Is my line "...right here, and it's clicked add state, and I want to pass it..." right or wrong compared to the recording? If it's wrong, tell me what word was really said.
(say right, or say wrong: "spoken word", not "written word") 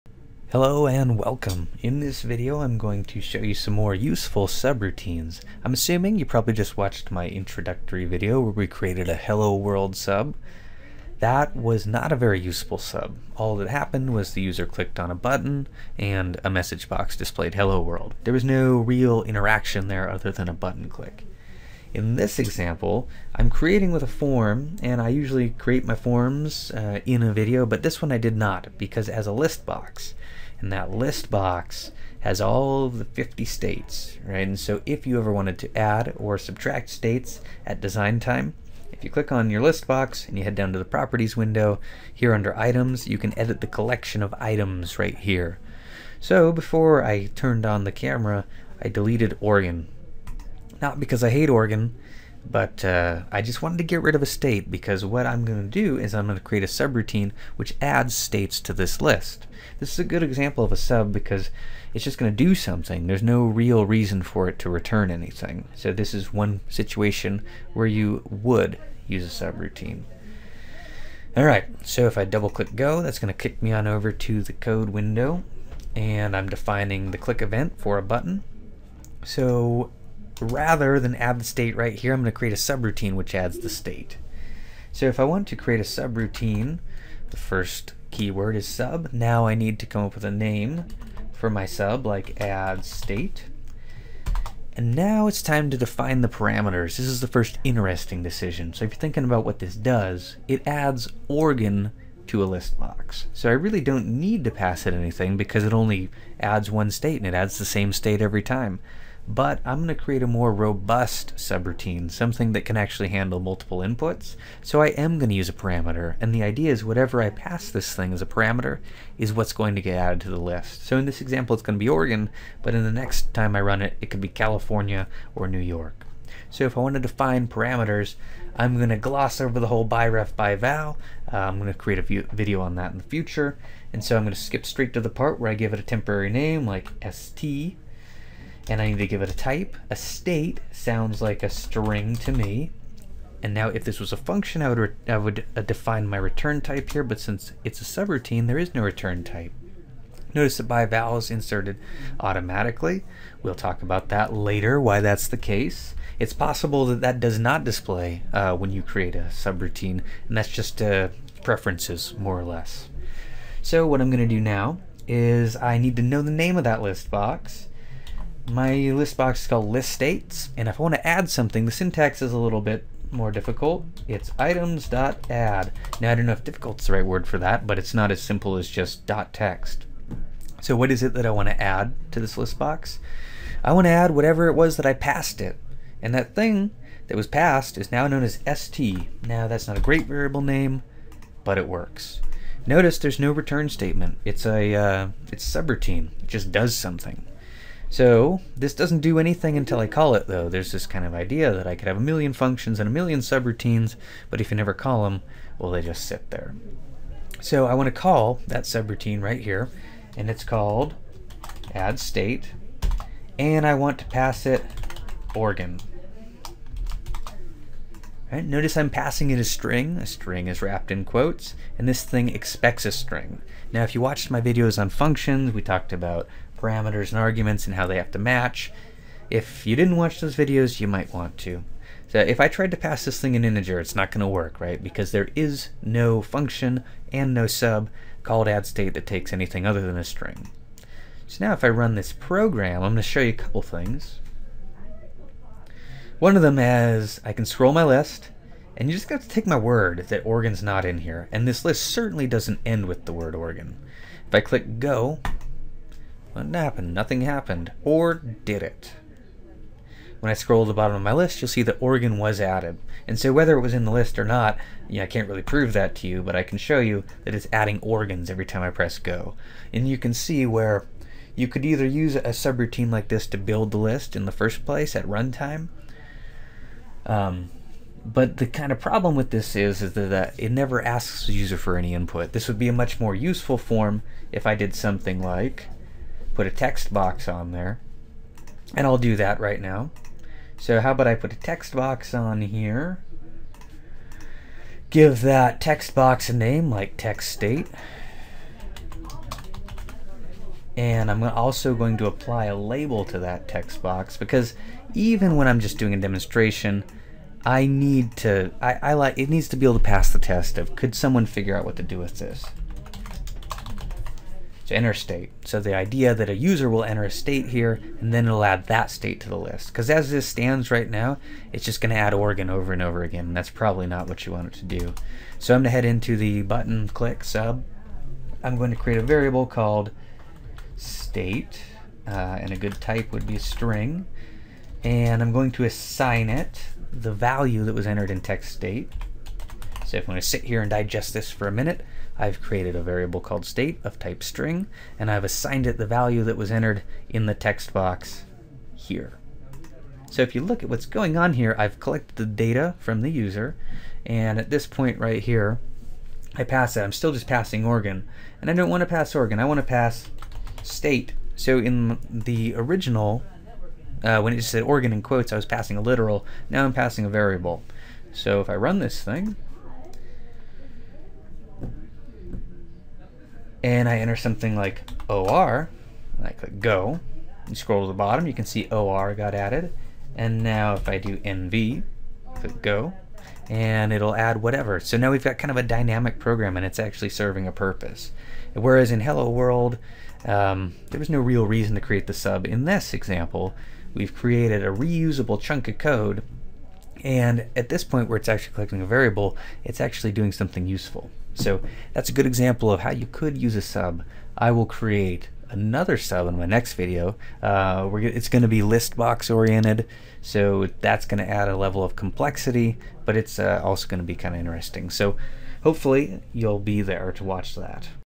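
wrong: "called", not "clicked".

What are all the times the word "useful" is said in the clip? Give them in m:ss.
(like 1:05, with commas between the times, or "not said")
0:03, 0:12, 4:43, 6:40.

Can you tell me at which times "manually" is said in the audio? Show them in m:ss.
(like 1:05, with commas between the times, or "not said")
not said.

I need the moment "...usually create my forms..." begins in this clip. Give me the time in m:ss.
0:25.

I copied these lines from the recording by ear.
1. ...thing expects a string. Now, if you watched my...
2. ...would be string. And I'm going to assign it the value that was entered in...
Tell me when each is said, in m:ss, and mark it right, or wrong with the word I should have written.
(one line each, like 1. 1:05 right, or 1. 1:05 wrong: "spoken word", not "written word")
1. 3:42 right
2. 5:33 right.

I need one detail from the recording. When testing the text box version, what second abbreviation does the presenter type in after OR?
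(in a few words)
NV.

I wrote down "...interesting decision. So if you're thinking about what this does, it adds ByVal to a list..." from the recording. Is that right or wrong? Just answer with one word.
wrong.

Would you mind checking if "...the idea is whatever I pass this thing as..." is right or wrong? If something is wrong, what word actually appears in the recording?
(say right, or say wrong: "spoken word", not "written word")
right.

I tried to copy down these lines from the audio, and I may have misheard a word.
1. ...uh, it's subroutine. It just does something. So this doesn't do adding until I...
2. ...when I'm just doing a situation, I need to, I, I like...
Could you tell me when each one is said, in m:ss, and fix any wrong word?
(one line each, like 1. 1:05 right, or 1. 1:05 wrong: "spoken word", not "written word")
1. 3:14 wrong: "anything", not "adding"
2. 5:05 wrong: "demonstration", not "situation".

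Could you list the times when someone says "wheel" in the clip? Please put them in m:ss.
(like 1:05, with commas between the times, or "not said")
not said.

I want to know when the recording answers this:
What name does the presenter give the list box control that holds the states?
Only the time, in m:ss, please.
2:49.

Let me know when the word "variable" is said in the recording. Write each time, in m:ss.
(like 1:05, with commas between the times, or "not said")
3:10, 5:29, 5:42, 6:07, 6:38.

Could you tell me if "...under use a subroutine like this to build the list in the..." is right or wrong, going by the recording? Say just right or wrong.
wrong.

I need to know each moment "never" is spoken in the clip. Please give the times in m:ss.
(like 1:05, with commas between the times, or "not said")
3:24, 4:40.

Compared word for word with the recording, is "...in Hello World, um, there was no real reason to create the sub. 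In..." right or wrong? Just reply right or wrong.
right.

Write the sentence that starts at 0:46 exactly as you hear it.
So before I turned on the camera, I deleted Oregon.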